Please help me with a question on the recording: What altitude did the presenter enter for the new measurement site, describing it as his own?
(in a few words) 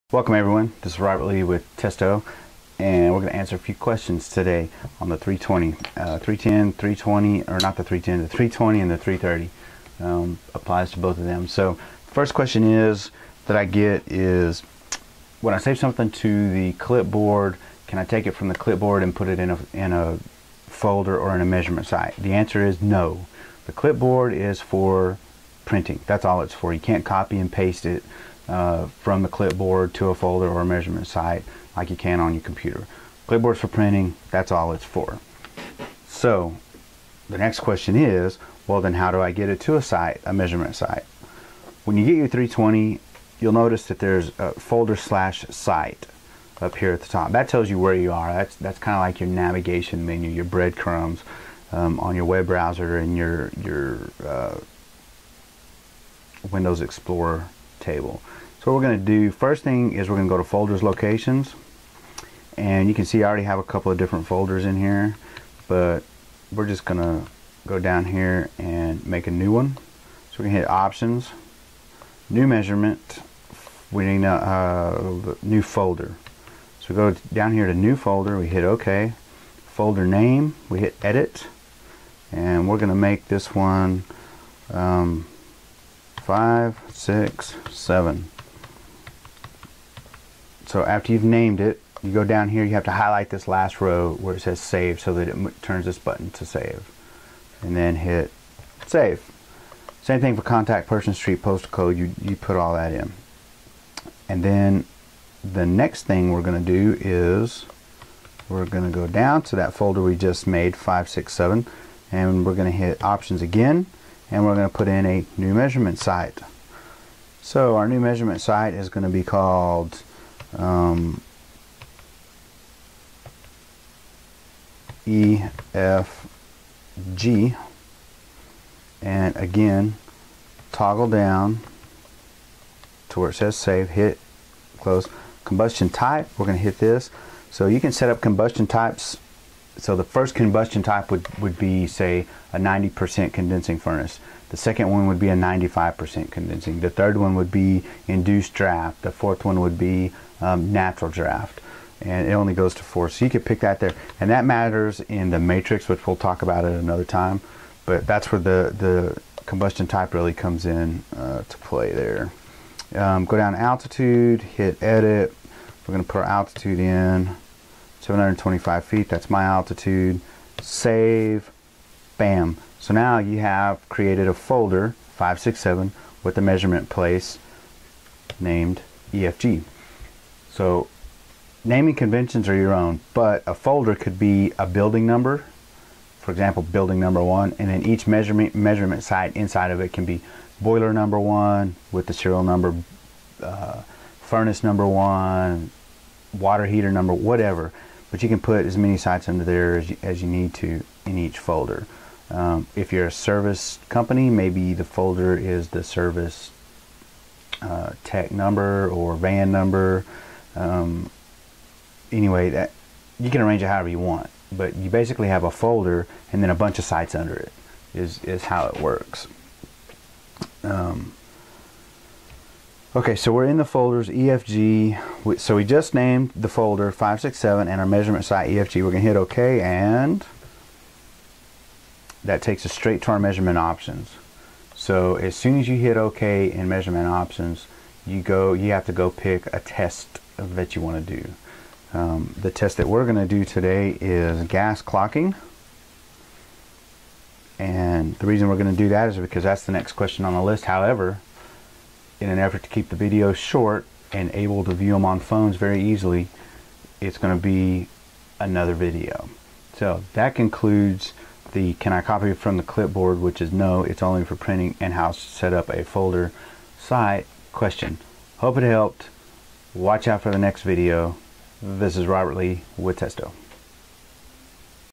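725 feet.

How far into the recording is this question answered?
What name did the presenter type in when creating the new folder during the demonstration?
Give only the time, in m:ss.
1:26.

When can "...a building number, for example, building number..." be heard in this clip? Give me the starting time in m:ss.
3:04.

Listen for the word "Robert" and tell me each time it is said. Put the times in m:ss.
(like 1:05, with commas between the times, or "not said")
0:00, 4:32.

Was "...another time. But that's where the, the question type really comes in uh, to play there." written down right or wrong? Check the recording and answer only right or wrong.
wrong.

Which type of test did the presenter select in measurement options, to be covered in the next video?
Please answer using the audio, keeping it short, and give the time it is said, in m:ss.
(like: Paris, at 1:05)
Gas clocking, at 4:04.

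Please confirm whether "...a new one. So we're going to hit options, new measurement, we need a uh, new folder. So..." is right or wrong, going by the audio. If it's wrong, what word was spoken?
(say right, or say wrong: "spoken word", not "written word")
right.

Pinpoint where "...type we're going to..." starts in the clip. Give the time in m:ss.
2:15.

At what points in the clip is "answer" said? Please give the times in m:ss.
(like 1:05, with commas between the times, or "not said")
0:03, 0:22.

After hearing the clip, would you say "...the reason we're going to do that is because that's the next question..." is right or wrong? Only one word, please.
right.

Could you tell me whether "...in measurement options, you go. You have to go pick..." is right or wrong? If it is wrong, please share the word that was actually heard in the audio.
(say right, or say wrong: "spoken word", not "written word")
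right.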